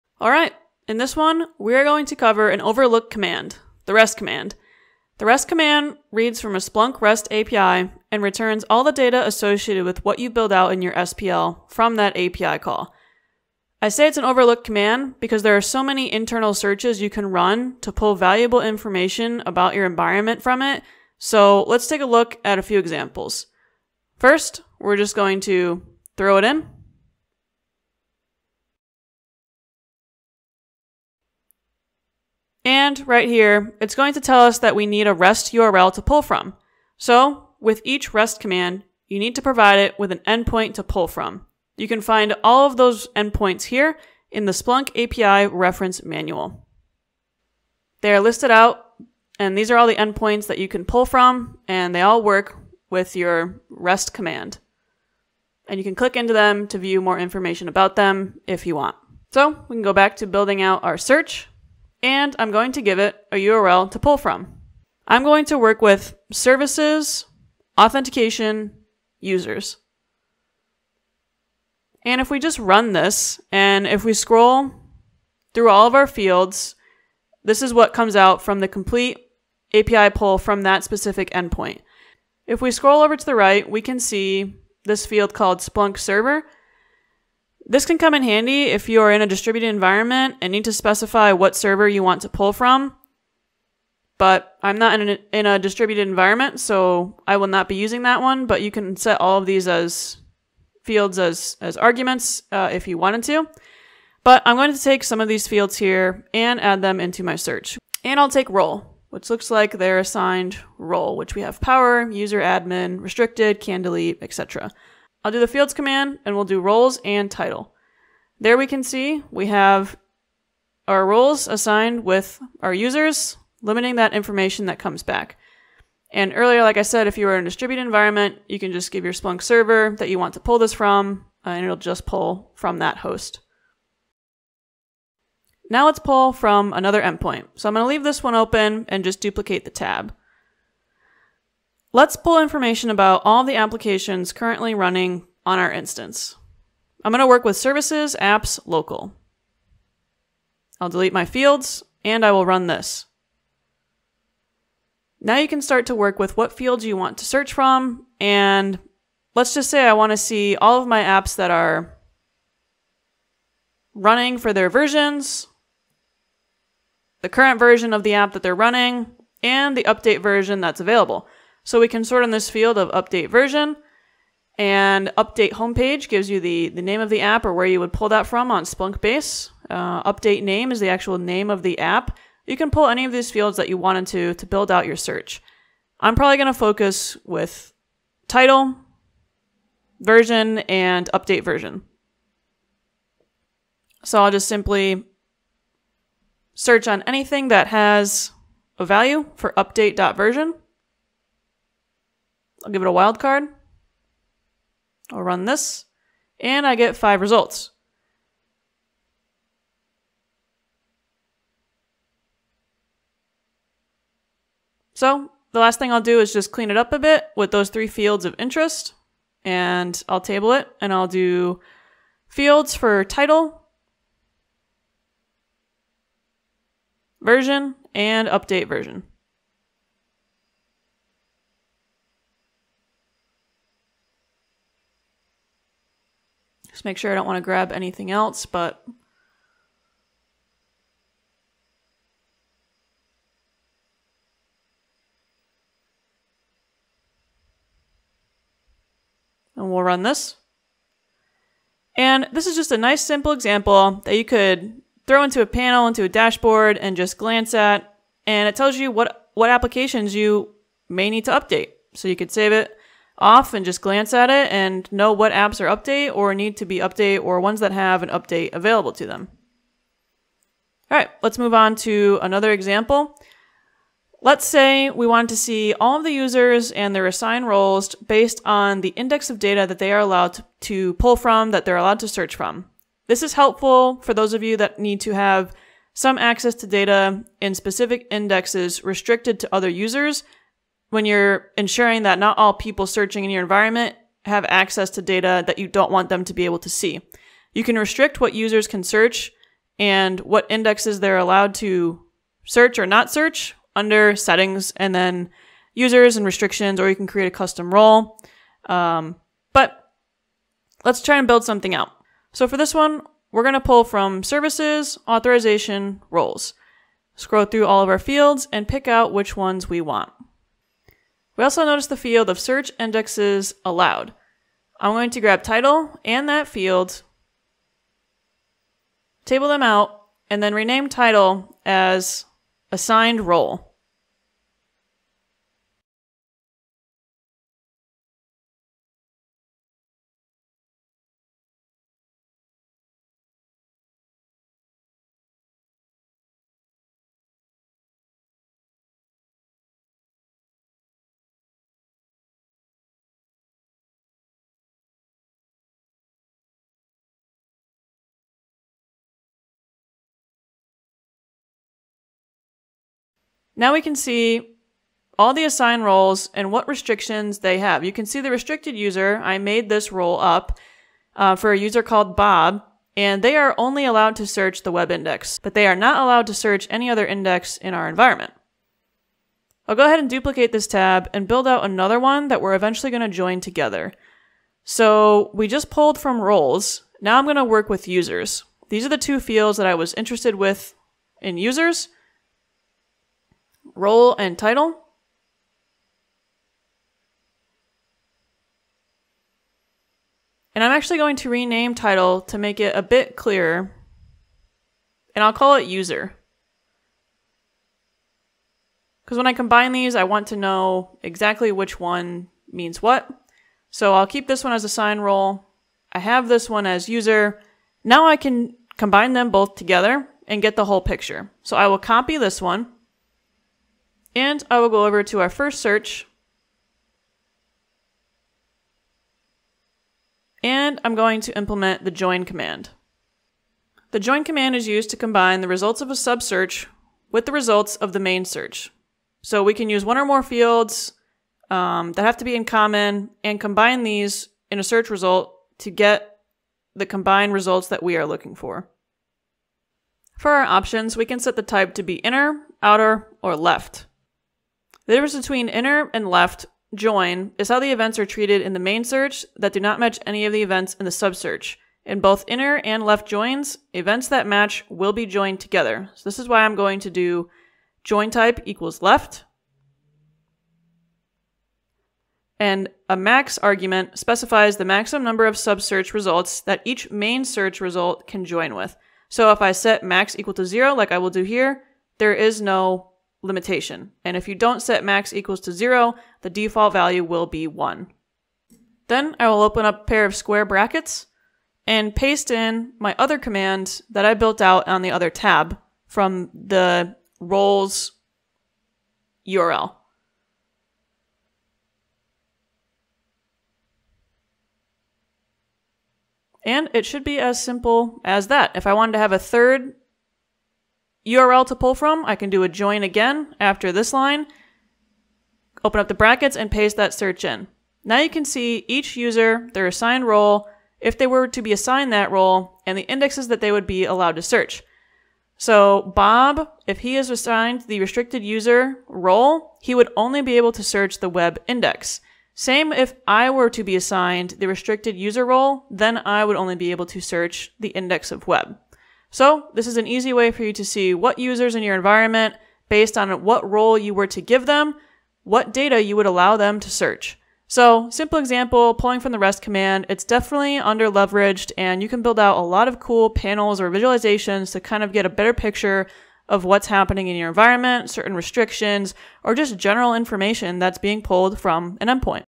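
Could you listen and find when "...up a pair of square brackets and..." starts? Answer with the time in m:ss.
8:09.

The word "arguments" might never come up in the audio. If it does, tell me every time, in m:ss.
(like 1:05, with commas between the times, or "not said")
1:41, 7:53.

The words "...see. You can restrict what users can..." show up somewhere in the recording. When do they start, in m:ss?
4:56.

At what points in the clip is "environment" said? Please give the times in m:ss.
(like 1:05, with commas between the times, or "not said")
0:19, 1:29, 1:36, 2:07, 4:53, 6:17, 9:01, 9:17.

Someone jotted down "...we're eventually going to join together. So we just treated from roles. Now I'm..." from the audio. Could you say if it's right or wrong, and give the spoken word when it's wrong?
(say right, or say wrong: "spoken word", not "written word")
wrong: "pulled", not "treated".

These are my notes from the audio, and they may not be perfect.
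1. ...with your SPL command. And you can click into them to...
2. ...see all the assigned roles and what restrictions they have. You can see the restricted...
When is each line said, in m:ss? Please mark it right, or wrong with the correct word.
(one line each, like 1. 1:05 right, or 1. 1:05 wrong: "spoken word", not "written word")
1. 0:52 wrong: "REST", not "SPL"
2. 6:03 right.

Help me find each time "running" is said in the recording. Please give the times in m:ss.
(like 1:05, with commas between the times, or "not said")
2:24, 2:43, 2:48.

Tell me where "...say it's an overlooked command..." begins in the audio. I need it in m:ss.
0:13.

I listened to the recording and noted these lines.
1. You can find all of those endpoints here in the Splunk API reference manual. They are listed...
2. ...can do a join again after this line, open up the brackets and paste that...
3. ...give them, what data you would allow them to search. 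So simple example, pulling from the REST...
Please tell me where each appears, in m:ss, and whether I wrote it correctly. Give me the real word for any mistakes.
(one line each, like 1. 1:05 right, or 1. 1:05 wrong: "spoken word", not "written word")
1. 0:41 right
2. 8:32 right
3. 9:04 right.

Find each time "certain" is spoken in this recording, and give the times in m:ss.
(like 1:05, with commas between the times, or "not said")
9:17.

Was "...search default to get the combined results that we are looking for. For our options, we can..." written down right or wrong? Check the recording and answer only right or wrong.
wrong.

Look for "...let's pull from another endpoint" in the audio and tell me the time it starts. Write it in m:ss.
2:15.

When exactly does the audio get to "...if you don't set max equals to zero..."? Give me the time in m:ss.
8:04.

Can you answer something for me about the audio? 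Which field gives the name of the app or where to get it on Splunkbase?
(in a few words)
update homepage.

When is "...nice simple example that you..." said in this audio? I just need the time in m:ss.
4:12.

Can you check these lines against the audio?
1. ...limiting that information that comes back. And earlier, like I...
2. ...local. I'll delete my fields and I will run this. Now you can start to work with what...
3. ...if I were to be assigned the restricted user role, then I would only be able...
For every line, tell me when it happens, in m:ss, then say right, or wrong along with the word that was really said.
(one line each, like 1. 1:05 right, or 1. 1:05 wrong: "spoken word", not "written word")
1. 2:03 right
2. 2:28 right
3. 8:52 right.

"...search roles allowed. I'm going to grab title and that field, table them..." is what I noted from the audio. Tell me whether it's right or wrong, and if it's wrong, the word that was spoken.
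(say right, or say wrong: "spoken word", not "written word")
wrong: "indexes", not "roles".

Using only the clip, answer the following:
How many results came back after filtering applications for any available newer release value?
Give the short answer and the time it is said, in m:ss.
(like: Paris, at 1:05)
5, at 3:26.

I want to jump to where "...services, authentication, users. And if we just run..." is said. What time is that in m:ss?
1:06.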